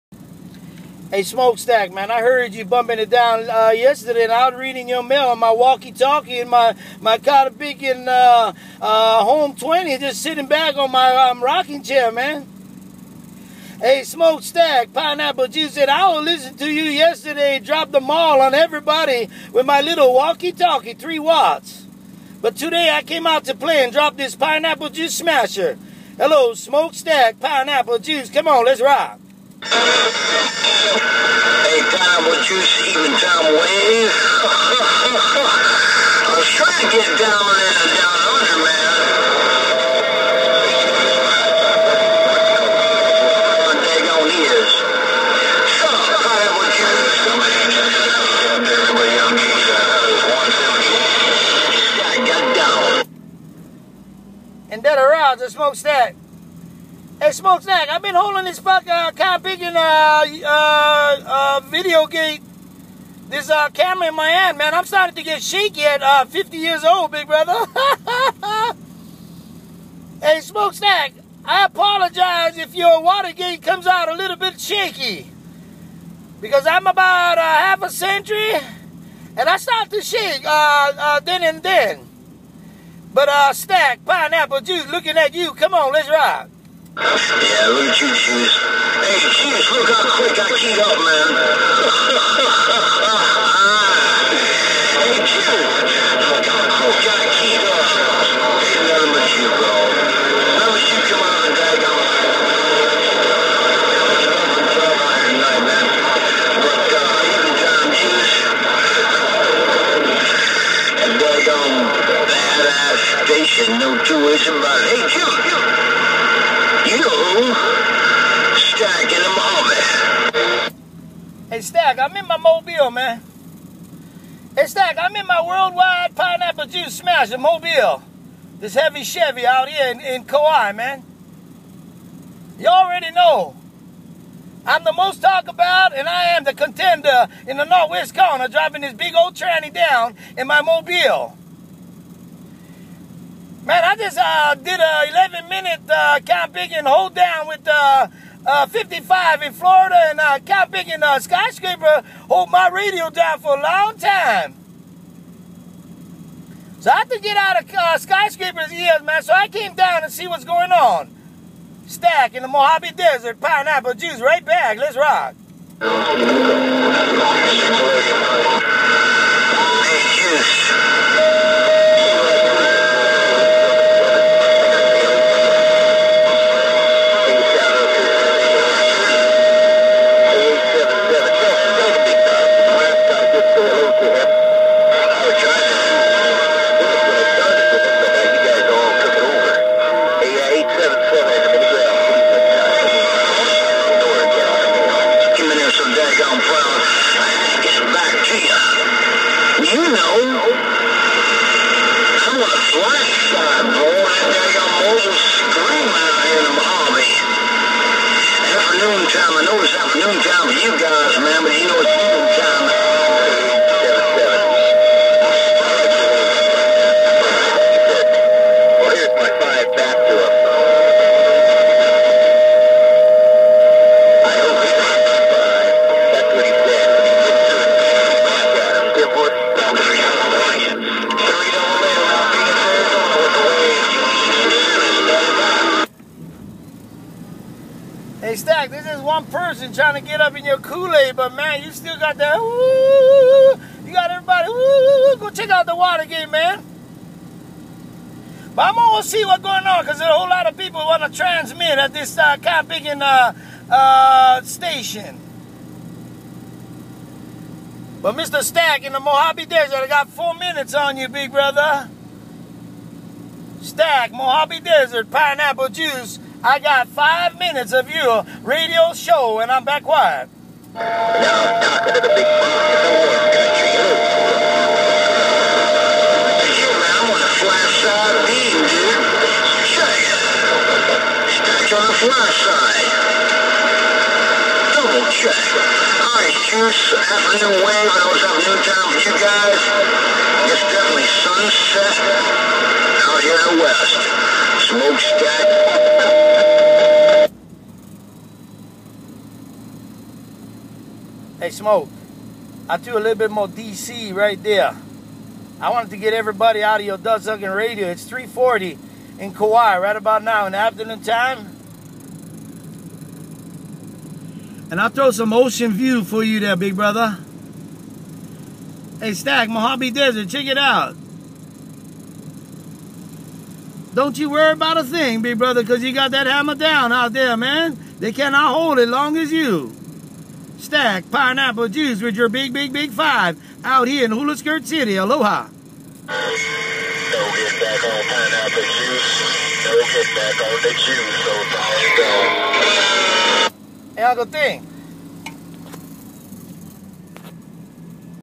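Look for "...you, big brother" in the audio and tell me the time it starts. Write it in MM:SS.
04:20.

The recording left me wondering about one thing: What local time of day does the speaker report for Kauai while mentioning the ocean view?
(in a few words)
3:40.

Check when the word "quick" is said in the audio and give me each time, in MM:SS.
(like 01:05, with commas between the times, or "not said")
01:30, 01:36.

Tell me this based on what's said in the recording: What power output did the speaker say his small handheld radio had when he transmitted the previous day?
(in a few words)
3 watts.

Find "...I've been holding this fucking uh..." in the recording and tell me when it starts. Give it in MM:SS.
00:57.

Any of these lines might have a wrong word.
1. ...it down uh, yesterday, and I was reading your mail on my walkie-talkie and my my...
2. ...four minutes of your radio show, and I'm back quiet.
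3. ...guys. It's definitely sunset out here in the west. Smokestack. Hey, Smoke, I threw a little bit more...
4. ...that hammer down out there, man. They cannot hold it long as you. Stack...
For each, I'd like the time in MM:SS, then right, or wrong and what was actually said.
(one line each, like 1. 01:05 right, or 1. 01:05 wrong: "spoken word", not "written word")
1. 00:02 right
2. 04:26 wrong: "five", not "four"
3. 04:49 right
4. 05:26 right.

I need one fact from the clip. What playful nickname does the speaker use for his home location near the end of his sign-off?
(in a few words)
Hula Skirt City.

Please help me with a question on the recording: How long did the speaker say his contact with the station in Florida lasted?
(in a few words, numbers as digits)
11 minutes.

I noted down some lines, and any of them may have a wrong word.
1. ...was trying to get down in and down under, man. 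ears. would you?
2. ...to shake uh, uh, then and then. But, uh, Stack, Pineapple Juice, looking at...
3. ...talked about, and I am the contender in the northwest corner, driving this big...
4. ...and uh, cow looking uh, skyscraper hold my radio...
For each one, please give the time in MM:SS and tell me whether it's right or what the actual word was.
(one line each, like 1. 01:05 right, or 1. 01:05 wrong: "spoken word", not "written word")
1. 00:36 right
2. 01:19 right
3. 02:15 right
4. 02:30 wrong: "picking", not "looking".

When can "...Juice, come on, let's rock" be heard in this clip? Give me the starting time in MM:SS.
00:27.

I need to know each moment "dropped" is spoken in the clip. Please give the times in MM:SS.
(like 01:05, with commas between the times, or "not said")
00:17, 00:23.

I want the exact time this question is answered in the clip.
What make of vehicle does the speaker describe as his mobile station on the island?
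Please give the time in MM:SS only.
02:09.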